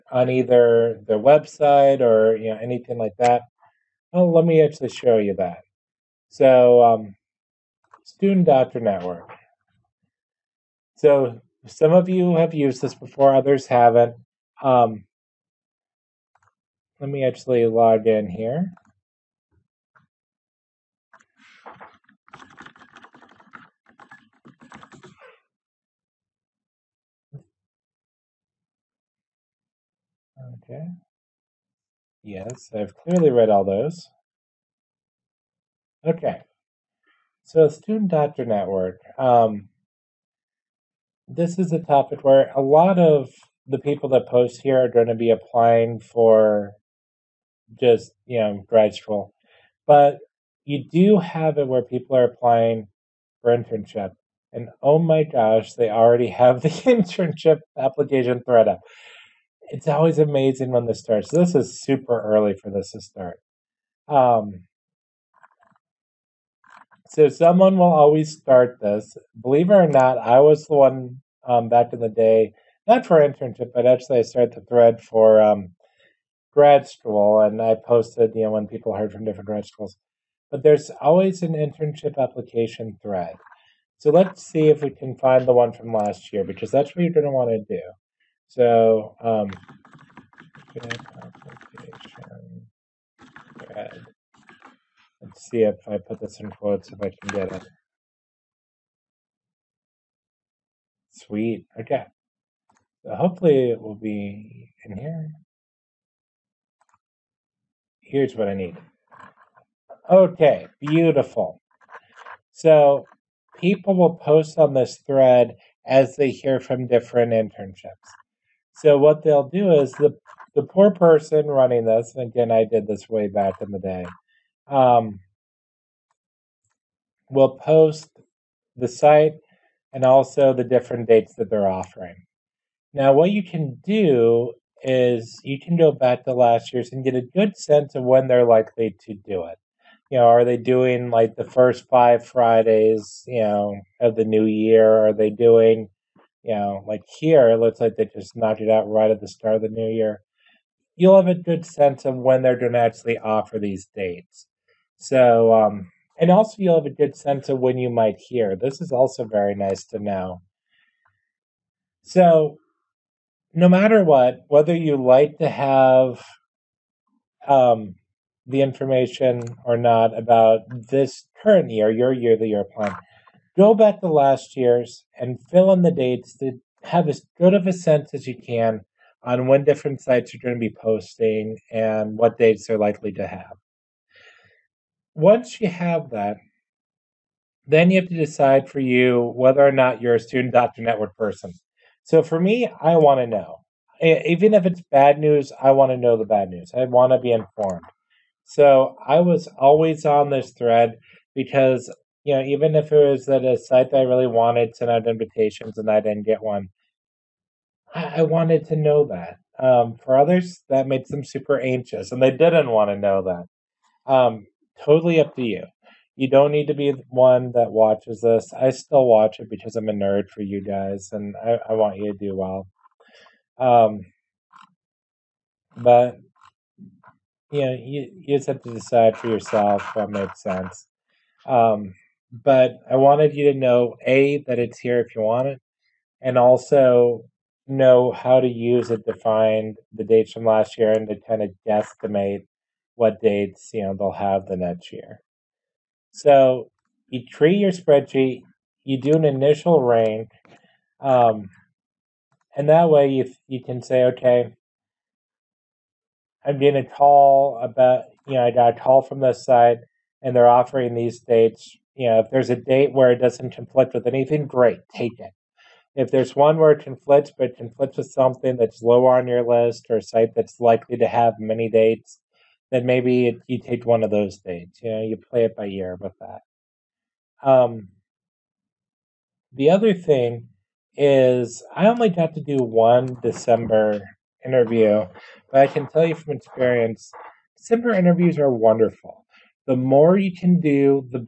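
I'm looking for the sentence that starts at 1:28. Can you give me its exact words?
So, um, Let's see if I put this in quotes if I can get it.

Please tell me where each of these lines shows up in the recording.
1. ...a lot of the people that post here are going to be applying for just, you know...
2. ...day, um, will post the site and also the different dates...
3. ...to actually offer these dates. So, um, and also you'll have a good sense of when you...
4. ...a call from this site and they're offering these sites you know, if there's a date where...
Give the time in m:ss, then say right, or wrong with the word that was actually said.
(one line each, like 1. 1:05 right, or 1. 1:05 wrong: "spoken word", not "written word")
1. 0:42 right
2. 2:03 right
3. 2:32 right
4. 4:18 wrong: "dates", not "sites".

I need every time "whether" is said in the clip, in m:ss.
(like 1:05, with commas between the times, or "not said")
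2:44, 3:09.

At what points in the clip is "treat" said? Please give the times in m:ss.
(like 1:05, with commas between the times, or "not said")
4:07.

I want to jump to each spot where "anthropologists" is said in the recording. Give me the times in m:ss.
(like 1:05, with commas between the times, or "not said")
not said.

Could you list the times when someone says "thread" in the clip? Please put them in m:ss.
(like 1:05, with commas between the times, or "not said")
0:58, 1:14, 1:23, 1:54, 3:20.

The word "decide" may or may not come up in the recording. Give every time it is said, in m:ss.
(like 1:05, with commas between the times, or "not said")
3:08, 3:48.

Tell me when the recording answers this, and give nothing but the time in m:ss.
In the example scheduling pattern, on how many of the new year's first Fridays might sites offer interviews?
2:21.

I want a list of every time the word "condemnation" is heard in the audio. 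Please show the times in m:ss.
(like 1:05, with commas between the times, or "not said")
not said.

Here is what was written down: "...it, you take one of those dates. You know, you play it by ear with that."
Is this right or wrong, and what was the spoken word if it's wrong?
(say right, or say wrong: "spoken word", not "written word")
right.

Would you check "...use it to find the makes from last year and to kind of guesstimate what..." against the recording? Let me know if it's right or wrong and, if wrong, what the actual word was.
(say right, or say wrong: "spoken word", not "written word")
wrong: "dates", not "makes".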